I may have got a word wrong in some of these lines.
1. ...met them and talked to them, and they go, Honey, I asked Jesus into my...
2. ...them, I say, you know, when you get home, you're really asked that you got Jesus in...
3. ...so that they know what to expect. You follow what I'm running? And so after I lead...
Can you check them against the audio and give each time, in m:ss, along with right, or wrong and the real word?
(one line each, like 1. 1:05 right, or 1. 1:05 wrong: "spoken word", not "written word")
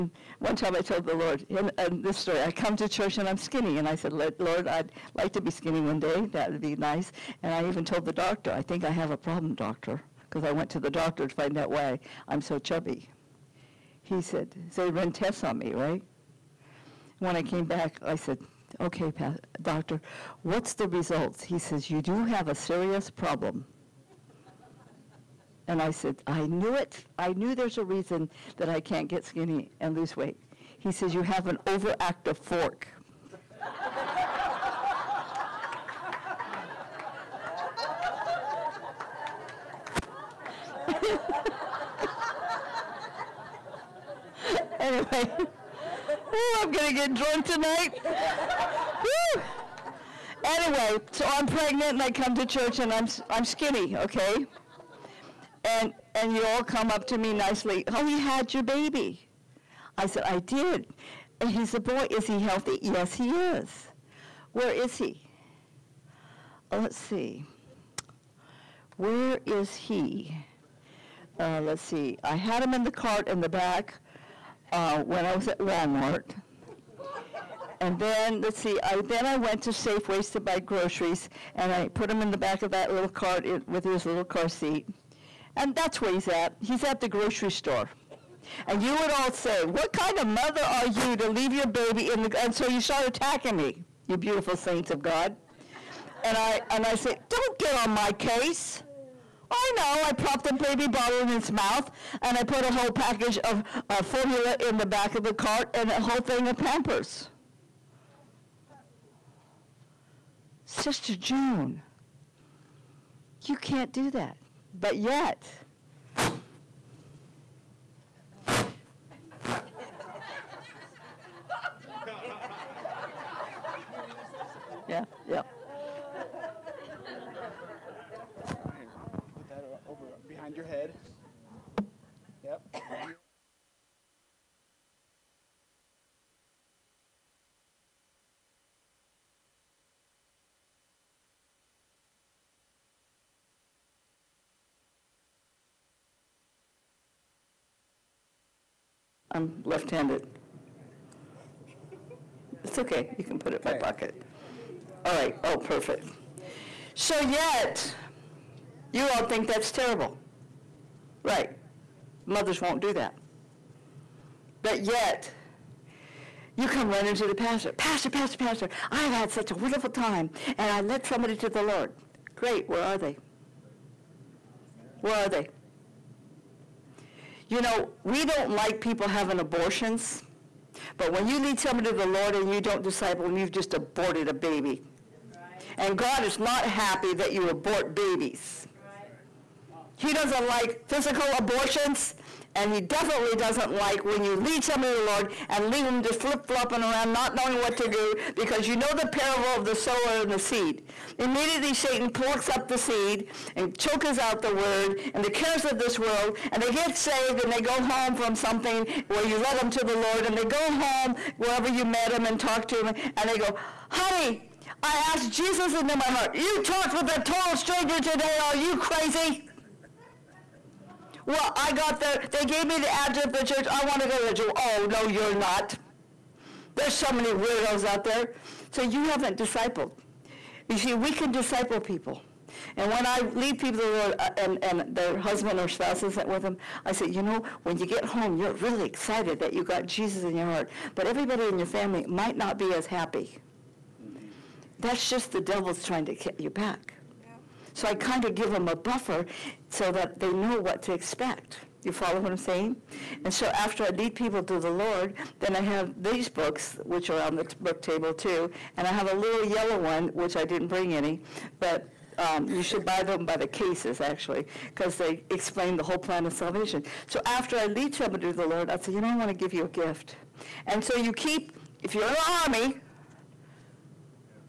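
1. 3:31 right
2. 3:56 wrong: "excited", not "asked"
3. 4:09 wrong: "saying", not "running".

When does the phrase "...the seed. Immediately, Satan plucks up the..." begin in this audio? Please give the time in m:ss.
3:20.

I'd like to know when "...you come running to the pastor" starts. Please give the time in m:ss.
2:46.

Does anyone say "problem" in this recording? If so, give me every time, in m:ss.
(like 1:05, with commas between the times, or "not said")
0:09, 0:23.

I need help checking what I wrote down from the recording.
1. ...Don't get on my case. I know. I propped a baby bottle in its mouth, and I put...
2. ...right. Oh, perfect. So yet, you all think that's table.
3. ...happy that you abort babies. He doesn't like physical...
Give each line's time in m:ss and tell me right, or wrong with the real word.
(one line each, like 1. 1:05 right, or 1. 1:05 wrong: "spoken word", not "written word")
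1. 1:37 right
2. 2:35 wrong: "terrible", not "table"
3. 3:06 right.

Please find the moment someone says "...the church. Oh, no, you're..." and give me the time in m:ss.
3:44.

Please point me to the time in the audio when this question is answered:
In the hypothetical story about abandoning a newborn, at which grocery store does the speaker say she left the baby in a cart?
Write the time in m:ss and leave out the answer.
1:19.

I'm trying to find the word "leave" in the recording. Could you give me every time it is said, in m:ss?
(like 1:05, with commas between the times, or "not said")
1:31, 3:15.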